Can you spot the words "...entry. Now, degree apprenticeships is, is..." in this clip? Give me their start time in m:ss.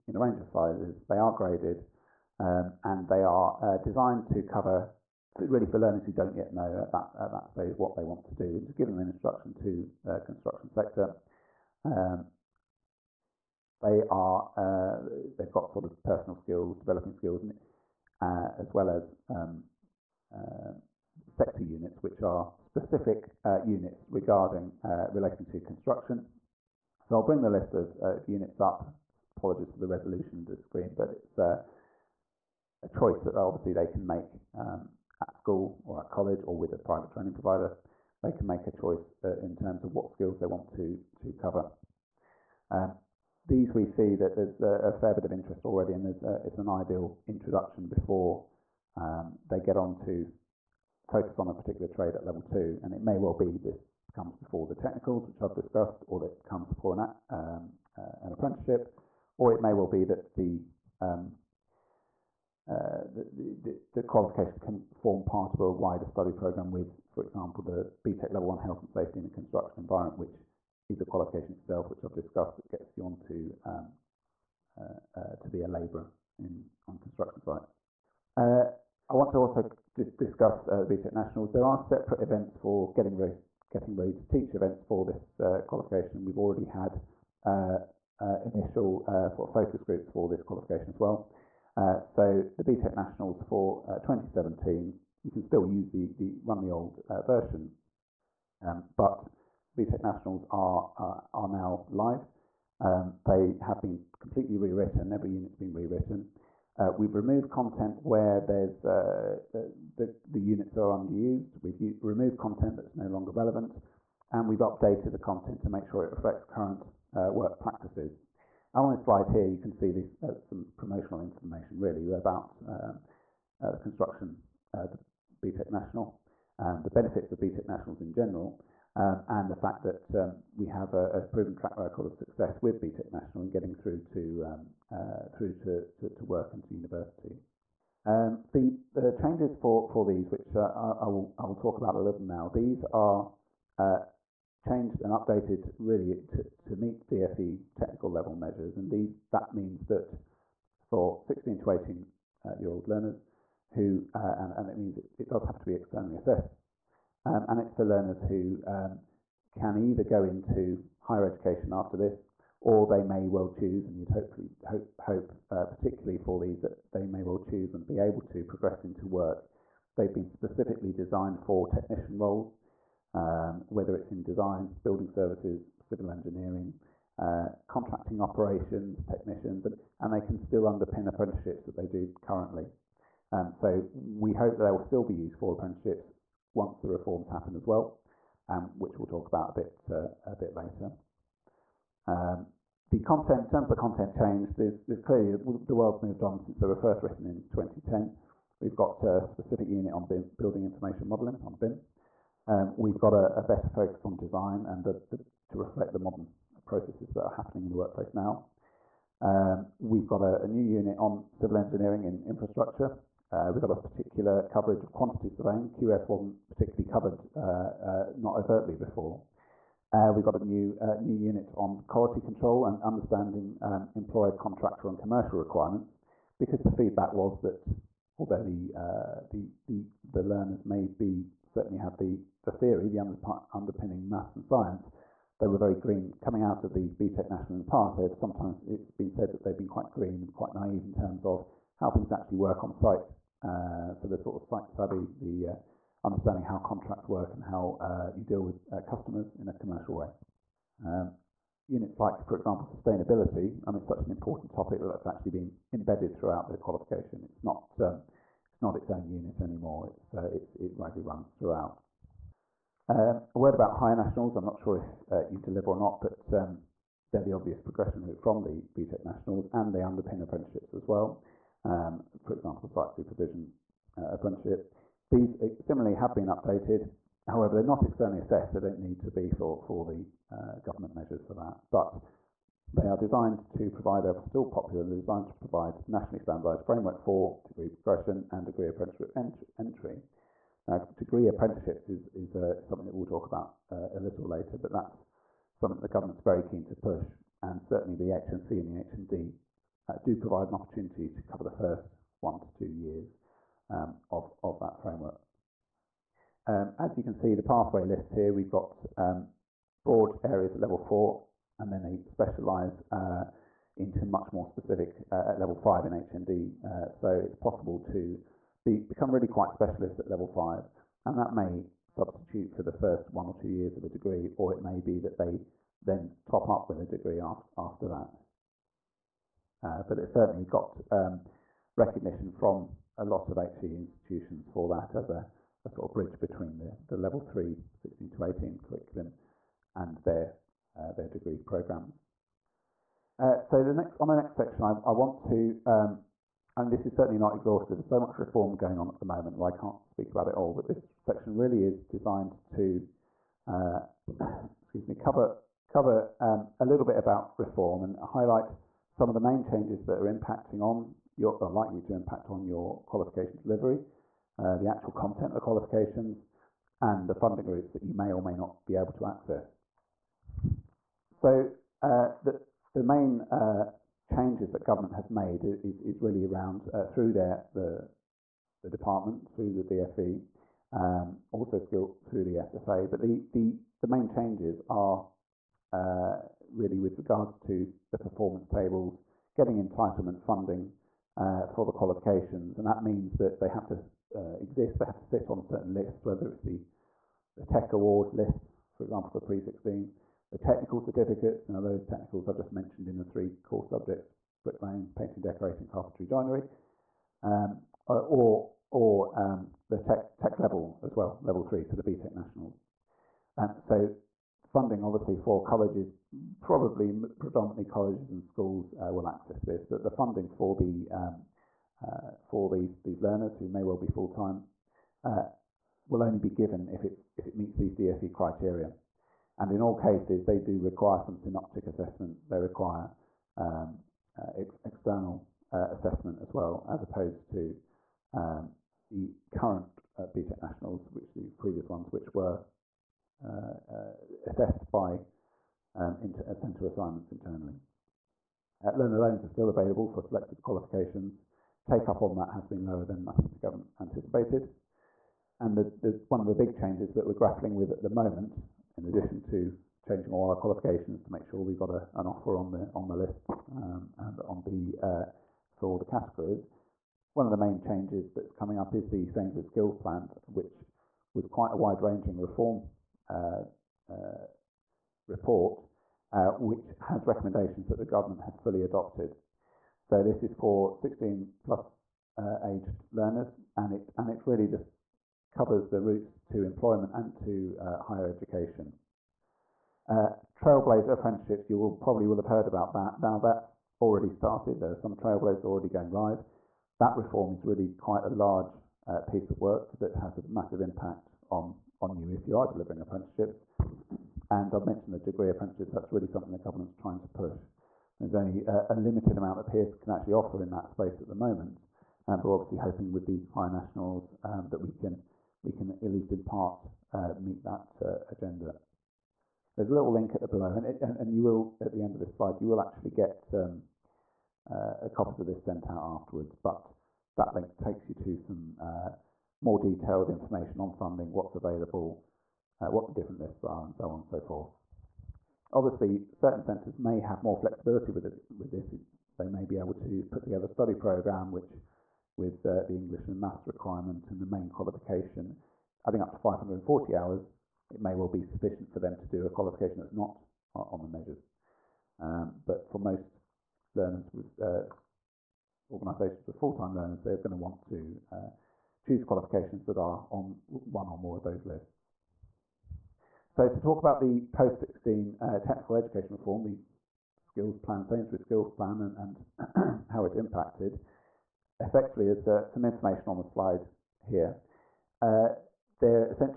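4:49.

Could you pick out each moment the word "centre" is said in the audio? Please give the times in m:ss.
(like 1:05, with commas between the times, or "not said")
7:26, 8:56.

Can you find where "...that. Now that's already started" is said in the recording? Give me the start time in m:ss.
8:12.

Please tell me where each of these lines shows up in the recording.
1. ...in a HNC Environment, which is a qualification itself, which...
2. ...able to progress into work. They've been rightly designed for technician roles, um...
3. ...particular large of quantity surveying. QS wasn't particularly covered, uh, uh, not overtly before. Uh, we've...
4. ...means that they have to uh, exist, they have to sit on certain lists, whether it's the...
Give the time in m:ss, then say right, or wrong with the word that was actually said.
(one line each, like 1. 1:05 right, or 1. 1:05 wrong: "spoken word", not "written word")
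1. 1:09 wrong: "Construction", not "HNC"
2. 2:47 wrong: "specifically", not "rightly"
3. 3:33 wrong: "coverage", not "large"
4. 6:32 right.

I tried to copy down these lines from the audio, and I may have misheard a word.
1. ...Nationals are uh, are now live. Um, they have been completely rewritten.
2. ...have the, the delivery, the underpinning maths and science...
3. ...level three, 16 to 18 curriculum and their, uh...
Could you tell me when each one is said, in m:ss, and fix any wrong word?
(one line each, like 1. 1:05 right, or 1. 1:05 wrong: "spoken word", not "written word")
1. 1:40 right
2. 3:51 wrong: "theory", not "delivery"
3. 5:36 right.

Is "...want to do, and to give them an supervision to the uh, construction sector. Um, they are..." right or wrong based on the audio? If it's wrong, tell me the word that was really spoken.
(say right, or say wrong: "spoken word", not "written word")
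wrong: "instruction", not "supervision".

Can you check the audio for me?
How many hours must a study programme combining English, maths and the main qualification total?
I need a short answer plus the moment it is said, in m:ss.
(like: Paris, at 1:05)
540, at 9:06.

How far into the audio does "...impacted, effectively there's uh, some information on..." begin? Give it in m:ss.
9:30.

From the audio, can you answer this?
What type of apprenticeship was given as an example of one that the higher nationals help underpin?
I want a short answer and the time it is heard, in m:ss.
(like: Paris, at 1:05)
Site supervision, at 4:32.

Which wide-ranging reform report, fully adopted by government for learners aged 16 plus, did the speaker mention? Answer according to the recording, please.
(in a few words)
Sainsbury's Skill Plan.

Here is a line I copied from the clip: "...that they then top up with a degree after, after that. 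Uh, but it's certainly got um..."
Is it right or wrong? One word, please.
right.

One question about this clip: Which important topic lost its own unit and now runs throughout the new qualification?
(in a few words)
Sustainability.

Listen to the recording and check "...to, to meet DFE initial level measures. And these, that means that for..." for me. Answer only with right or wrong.
wrong.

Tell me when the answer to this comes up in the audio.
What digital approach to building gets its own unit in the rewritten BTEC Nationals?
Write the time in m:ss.
3:20.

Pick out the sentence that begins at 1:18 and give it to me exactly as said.
Uh, I want to also just discuss uh, BTEC Nationals.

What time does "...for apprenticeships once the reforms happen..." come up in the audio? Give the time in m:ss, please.
3:05.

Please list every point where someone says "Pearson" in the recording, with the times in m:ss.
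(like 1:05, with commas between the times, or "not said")
8:29.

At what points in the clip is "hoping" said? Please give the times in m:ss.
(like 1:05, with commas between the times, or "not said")
8:32.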